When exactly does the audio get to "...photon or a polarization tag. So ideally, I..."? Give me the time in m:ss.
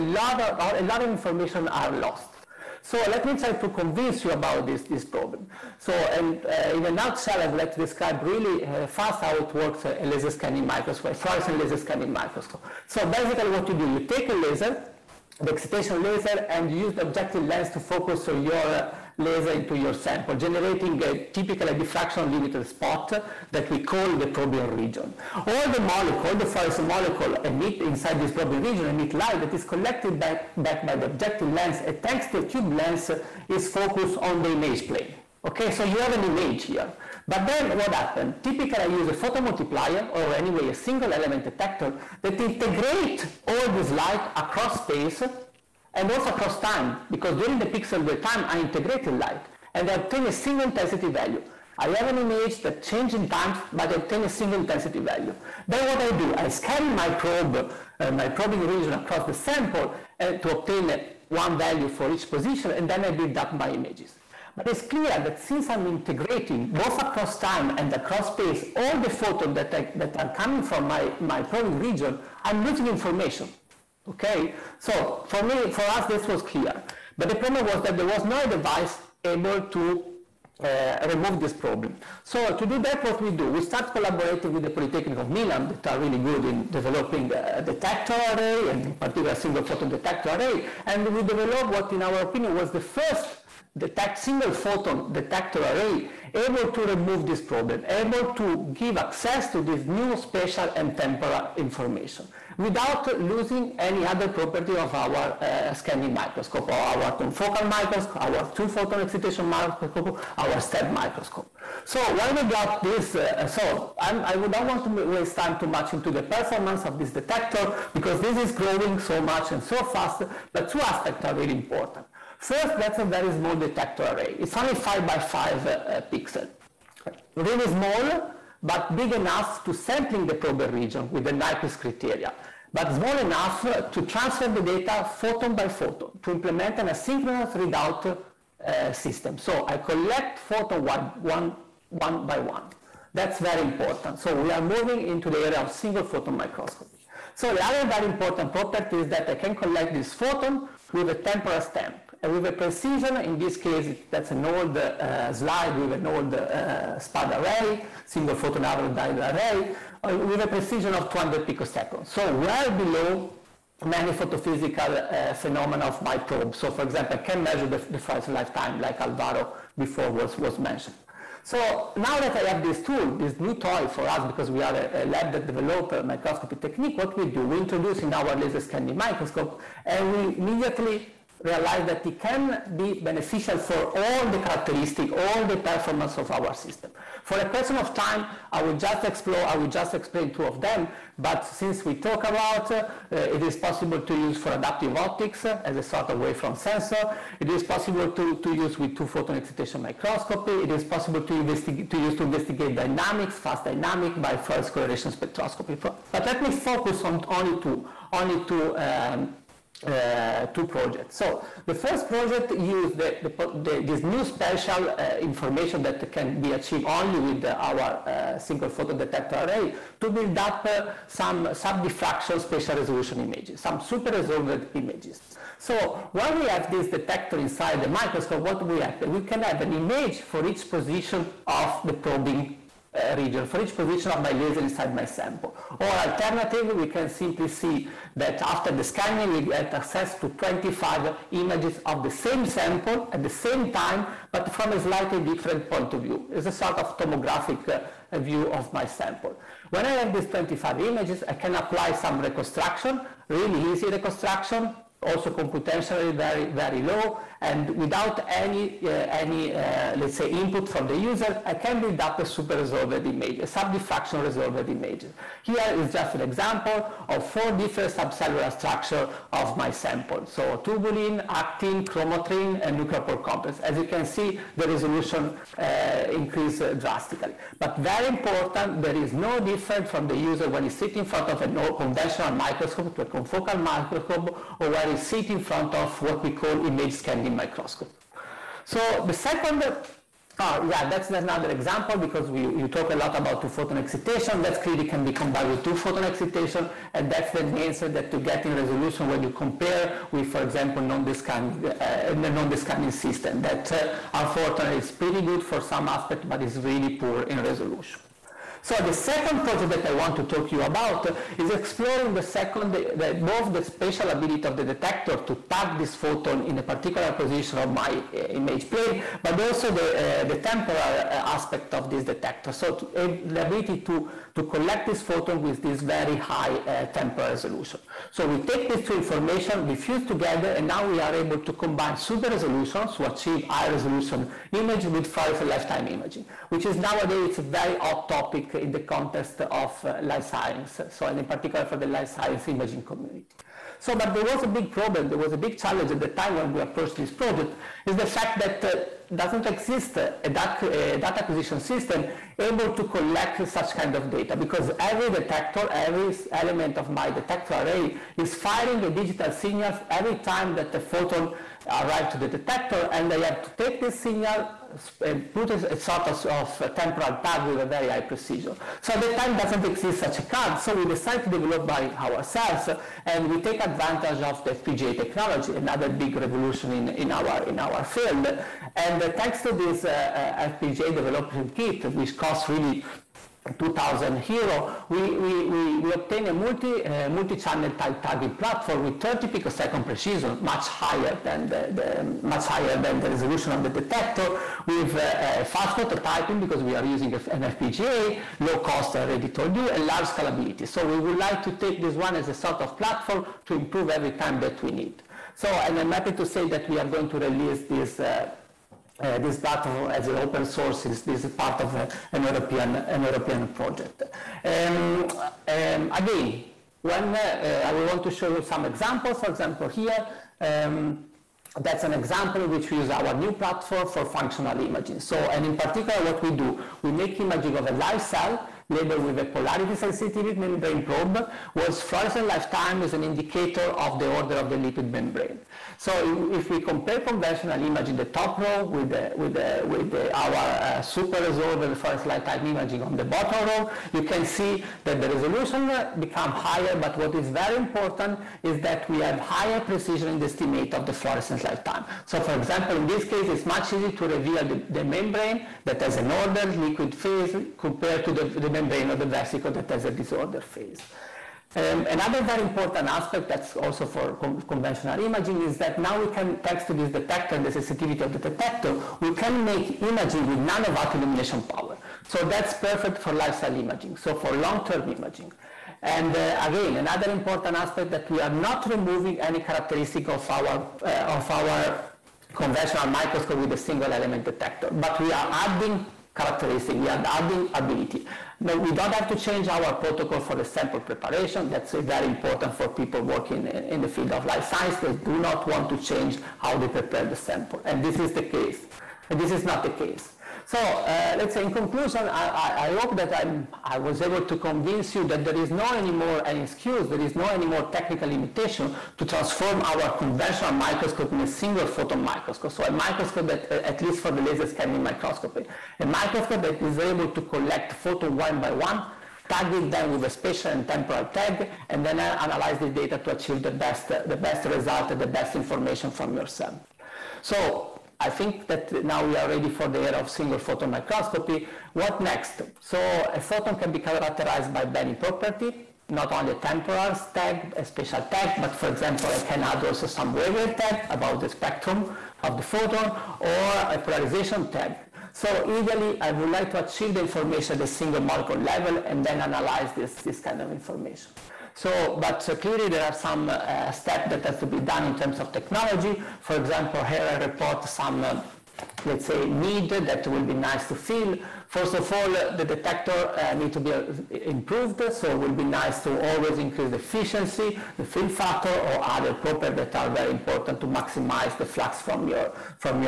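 9:02.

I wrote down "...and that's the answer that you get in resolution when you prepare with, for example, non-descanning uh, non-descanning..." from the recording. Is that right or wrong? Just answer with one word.
wrong.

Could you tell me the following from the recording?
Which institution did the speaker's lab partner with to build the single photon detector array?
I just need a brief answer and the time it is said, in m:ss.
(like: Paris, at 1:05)
Polytechnic of Milan, at 1:24.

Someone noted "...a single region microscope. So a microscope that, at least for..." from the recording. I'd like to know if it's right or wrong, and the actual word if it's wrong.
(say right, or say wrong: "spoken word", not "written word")
wrong: "photon", not "region".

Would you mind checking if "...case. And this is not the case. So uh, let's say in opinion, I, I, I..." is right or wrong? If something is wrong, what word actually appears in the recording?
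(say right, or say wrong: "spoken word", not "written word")
wrong: "conclusion", not "opinion".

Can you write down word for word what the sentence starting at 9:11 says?
So, but uh, clearly there are some uh, that has to be done in terms of technology.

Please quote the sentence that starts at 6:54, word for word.
Um, um, again, when uh, uh, I will want to show you some examples, for example, here.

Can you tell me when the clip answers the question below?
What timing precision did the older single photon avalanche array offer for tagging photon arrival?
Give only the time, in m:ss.
2:41.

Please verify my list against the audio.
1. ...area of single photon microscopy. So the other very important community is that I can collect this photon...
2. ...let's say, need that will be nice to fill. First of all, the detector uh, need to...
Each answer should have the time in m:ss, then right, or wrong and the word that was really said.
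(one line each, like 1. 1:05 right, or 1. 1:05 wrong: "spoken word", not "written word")
1. 2:25 wrong: "property", not "community"
2. 9:18 right.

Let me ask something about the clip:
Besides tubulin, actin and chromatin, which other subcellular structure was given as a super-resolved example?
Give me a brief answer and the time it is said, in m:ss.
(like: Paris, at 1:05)
nucleopore complex, at 4:32.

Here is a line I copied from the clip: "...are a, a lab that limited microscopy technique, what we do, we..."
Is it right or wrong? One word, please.
wrong.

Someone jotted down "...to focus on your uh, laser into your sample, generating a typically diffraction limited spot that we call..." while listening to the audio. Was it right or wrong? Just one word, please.
right.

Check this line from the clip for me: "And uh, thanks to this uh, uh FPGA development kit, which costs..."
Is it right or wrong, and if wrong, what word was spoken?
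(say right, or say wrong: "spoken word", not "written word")
right.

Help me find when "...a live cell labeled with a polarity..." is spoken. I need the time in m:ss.
7:07.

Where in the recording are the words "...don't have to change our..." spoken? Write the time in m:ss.
8:08.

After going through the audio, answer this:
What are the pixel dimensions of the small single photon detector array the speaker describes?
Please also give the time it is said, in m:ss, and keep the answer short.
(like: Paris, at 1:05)
5 by 5, at 2:04.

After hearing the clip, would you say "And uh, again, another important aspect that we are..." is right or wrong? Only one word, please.
right.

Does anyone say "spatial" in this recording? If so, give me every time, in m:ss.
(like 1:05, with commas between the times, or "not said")
1:40, 3:42, 5:13, 8:40, 8:57.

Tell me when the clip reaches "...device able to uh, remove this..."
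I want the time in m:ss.
1:18.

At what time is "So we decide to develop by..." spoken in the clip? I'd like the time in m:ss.
6:10.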